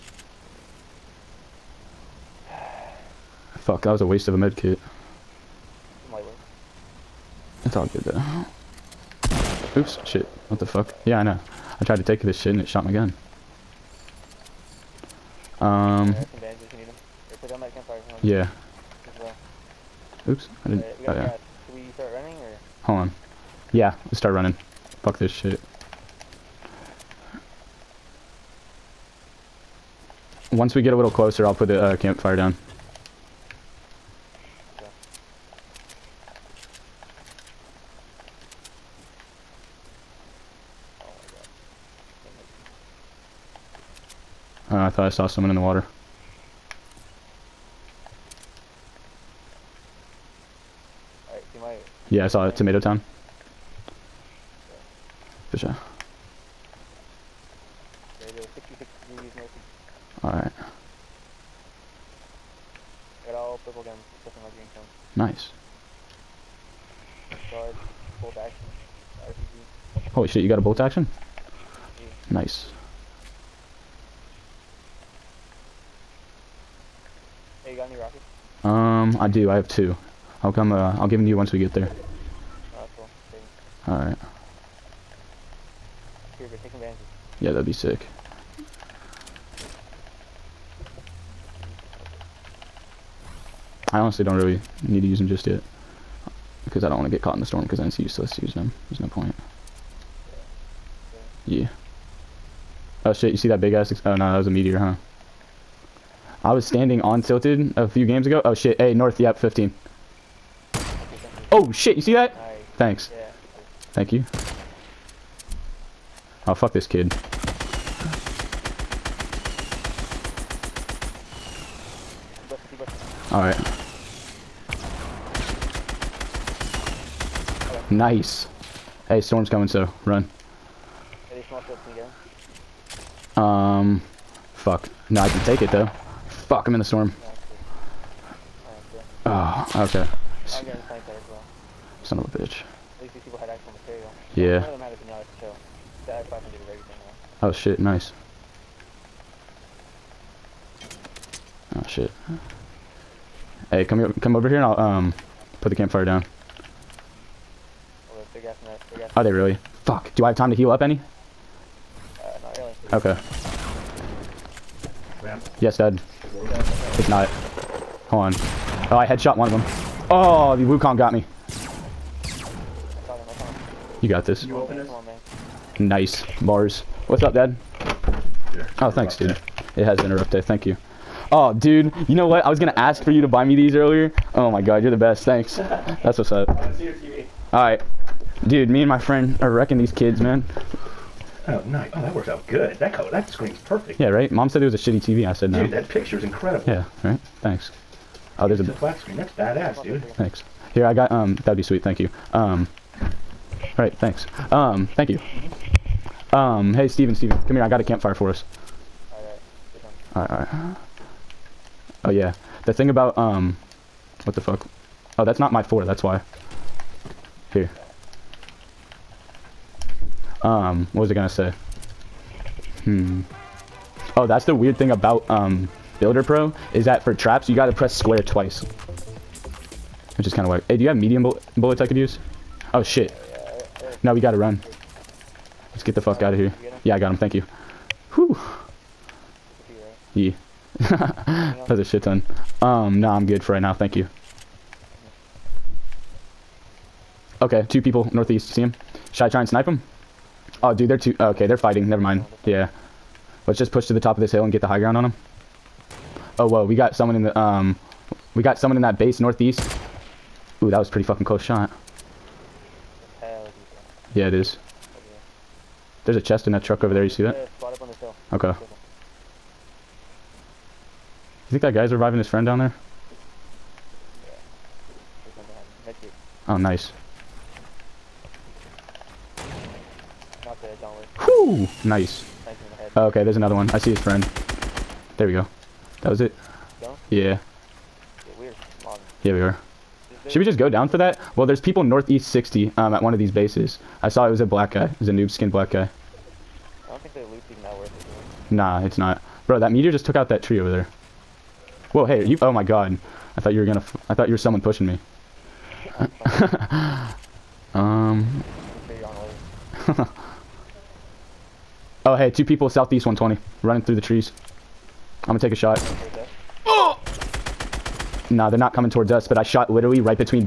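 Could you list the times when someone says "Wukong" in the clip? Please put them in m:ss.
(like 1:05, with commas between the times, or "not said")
2:50.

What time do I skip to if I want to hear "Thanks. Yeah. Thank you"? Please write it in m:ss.
1:52.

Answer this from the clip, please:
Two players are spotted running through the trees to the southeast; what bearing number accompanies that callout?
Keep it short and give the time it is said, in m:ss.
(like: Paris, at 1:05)
120, at 5:13.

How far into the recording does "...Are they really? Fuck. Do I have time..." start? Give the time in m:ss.
2:39.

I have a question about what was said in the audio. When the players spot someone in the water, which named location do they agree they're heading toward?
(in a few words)
Tomato Town.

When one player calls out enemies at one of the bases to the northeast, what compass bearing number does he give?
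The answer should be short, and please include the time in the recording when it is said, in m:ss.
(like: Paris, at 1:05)
60, at 4:52.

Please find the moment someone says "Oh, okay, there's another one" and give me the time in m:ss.
4:42.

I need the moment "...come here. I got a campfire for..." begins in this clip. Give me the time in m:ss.
3:27.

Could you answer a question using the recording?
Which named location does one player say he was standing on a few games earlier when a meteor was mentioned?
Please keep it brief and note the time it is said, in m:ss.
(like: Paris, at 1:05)
Tilted, at 1:47.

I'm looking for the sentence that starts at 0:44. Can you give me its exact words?
Uh, I thought I saw someone in the water.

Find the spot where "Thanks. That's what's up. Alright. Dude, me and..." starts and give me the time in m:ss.
3:05.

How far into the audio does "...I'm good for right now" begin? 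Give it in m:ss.
4:03.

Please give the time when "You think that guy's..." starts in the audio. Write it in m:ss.
4:31.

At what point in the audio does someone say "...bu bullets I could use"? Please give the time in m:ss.
3:51.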